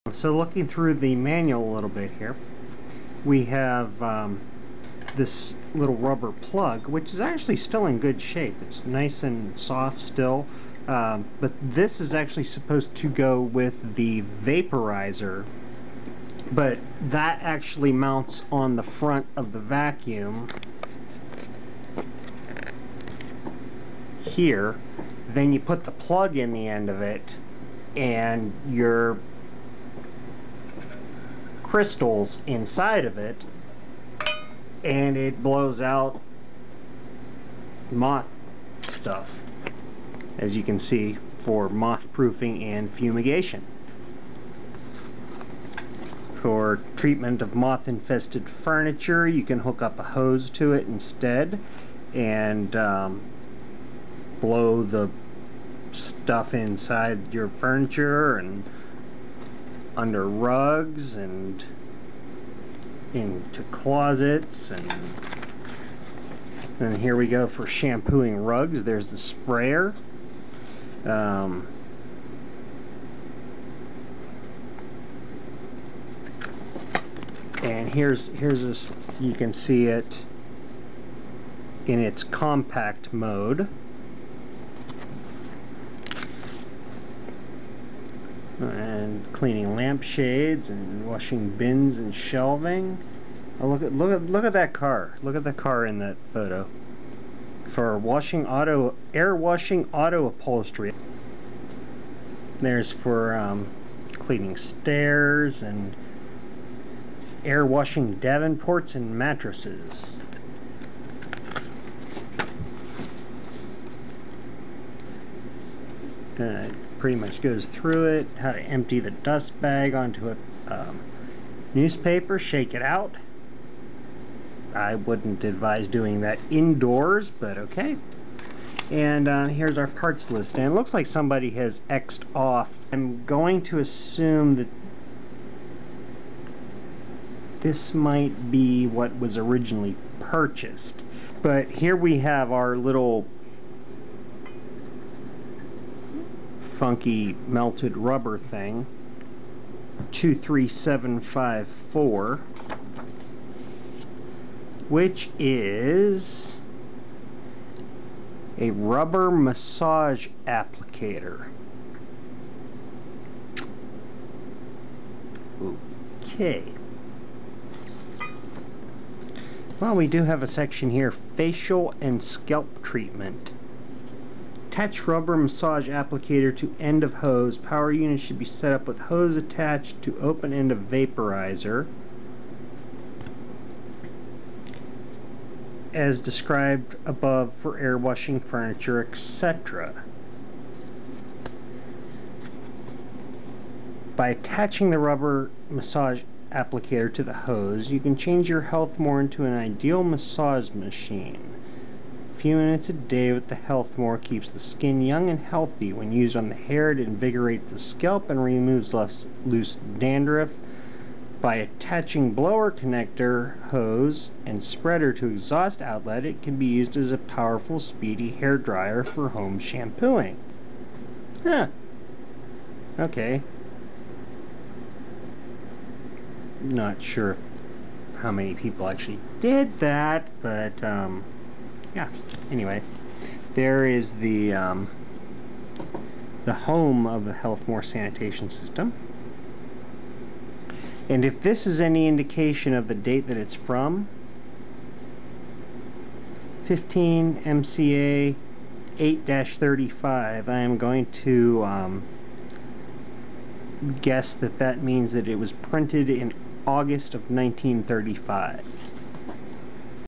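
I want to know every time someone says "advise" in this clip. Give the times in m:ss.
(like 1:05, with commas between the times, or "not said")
2:05.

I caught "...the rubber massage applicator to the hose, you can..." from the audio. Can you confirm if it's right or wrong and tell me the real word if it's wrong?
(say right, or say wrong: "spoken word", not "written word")
right.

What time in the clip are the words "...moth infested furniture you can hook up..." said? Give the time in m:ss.
0:47.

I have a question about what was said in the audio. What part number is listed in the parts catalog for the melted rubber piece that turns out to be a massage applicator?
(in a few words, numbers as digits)
23754.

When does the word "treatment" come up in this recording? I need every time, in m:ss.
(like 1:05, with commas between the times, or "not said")
0:46, 2:52.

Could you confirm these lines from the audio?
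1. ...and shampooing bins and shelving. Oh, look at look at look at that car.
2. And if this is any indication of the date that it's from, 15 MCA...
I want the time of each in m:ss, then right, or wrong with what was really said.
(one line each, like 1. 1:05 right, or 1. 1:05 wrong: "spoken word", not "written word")
1. 1:30 wrong: "washing", not "shampooing"
2. 4:01 right.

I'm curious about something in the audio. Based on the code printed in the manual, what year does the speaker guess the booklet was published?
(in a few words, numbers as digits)
1935.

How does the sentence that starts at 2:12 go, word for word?
I'm going to assume that this might be what was originally purchased.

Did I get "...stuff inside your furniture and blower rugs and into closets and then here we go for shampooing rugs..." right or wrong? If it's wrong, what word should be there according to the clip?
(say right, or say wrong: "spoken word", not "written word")
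wrong: "under", not "blower".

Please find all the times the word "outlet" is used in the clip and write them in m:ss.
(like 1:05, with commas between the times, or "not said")
3:35.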